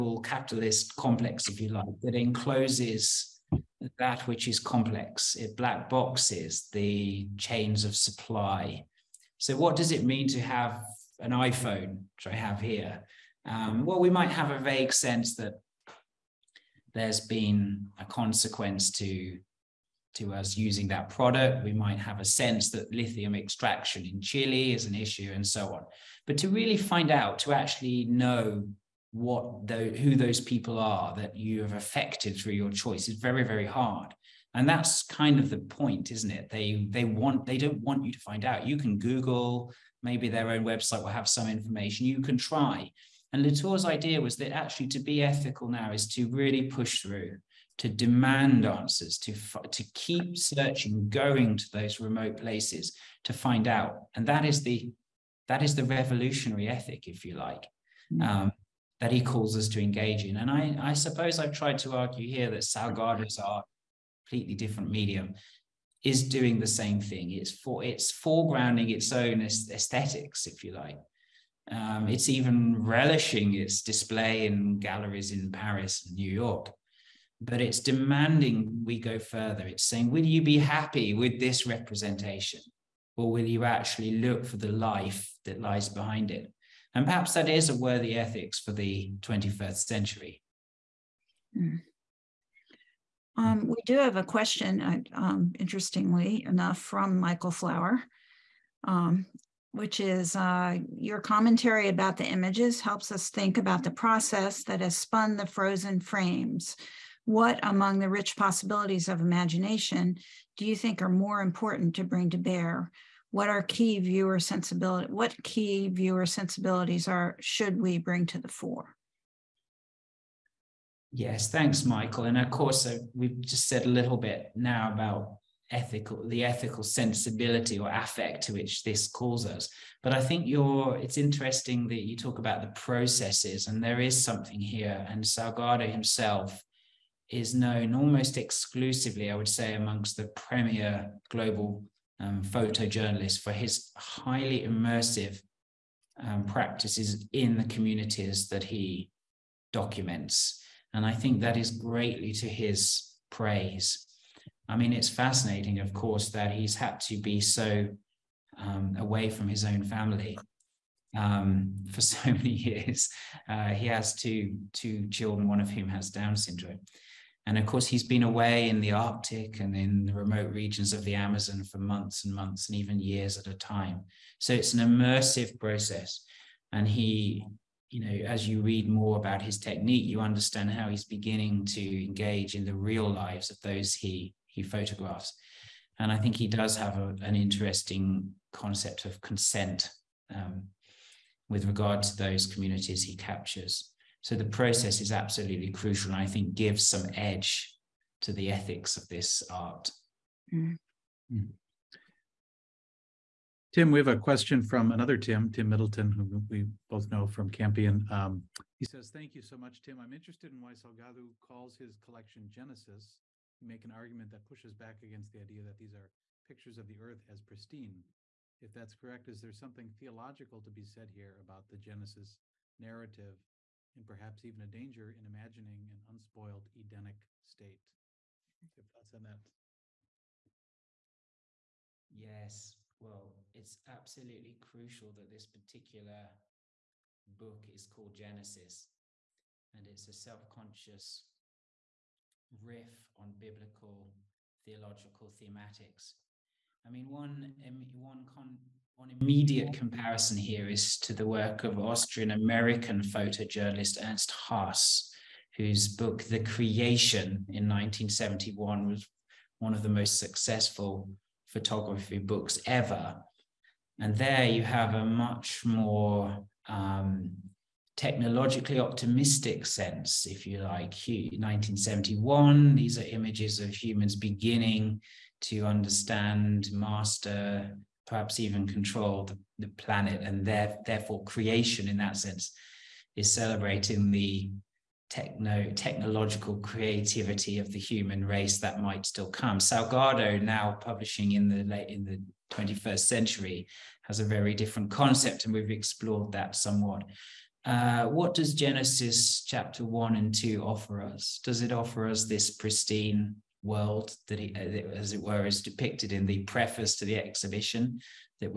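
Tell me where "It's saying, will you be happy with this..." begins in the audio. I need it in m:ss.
1:19.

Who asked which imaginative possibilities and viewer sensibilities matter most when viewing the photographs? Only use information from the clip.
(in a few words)
Michael Flower.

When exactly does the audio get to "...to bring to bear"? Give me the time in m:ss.
1:51.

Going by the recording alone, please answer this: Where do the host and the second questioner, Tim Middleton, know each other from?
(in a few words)
Campion.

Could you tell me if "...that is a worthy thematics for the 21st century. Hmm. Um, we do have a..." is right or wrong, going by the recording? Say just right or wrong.
wrong.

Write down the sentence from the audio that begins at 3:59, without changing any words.
And it's a self conscious riff on biblical theological thematics.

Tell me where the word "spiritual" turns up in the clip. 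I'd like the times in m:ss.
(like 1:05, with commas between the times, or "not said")
not said.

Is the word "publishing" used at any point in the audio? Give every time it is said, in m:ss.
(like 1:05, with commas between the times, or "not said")
4:50.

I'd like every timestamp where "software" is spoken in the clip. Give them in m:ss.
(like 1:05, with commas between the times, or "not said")
not said.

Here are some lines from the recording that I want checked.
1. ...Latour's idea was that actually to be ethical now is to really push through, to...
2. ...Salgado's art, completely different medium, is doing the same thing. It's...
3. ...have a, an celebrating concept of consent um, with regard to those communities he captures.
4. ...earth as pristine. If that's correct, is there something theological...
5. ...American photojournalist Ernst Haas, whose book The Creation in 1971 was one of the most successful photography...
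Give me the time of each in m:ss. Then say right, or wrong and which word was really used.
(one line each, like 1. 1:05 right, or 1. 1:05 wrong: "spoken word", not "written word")
1. 0:43 right
2. 1:02 right
3. 3:06 wrong: "interesting", not "celebrating"
4. 3:36 right
5. 4:12 right.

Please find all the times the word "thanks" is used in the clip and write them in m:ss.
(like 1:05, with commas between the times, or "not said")
2:01, 3:29.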